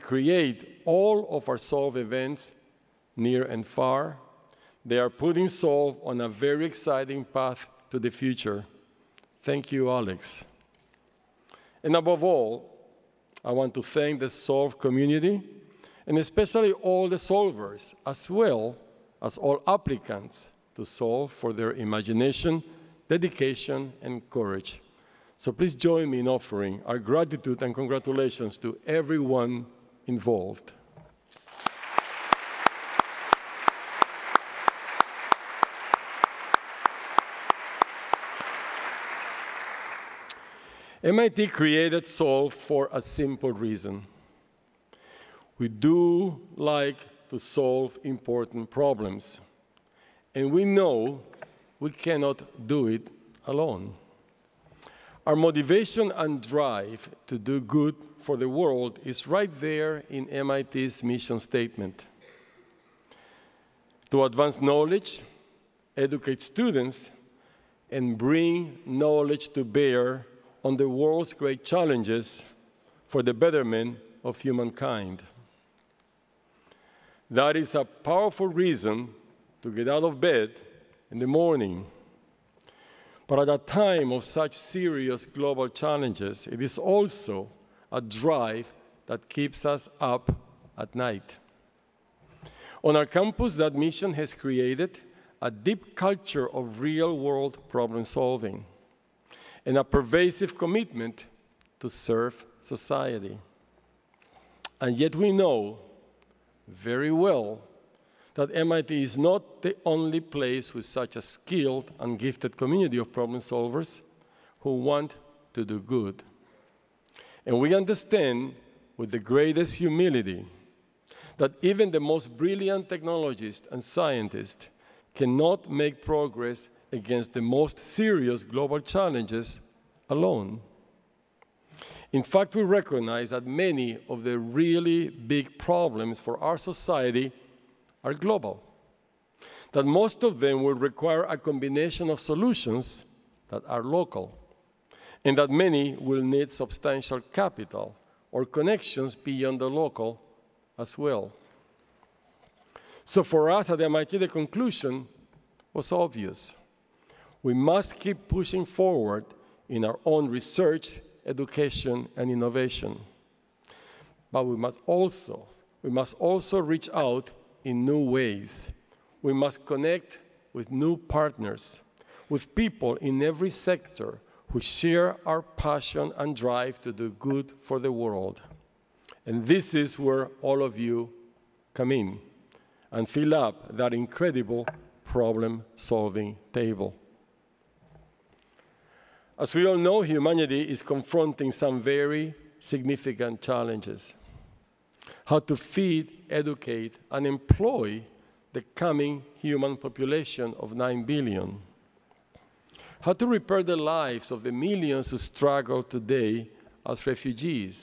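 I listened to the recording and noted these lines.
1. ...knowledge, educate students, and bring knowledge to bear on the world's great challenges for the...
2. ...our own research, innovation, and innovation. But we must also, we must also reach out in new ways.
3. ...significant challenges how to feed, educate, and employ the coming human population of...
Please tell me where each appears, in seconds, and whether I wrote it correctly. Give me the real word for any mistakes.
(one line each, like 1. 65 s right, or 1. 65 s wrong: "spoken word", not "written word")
1. 64 s right
2. 159 s wrong: "education", not "innovation"
3. 192 s right.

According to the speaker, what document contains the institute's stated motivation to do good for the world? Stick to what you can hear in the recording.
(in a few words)
MIT's mission statement.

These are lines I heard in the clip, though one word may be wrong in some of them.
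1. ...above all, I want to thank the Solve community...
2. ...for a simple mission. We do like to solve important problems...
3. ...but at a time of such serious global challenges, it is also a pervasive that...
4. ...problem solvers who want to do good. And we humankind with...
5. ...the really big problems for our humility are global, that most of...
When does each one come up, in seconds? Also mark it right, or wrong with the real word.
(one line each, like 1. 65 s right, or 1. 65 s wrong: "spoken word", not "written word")
1. 11 s right
2. 42 s wrong: "reason", not "mission"
3. 83 s wrong: "drive", not "pervasive"
4. 113 s wrong: "understand", not "humankind"
5. 134 s wrong: "society", not "humility".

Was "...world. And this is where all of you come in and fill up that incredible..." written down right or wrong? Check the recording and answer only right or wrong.
right.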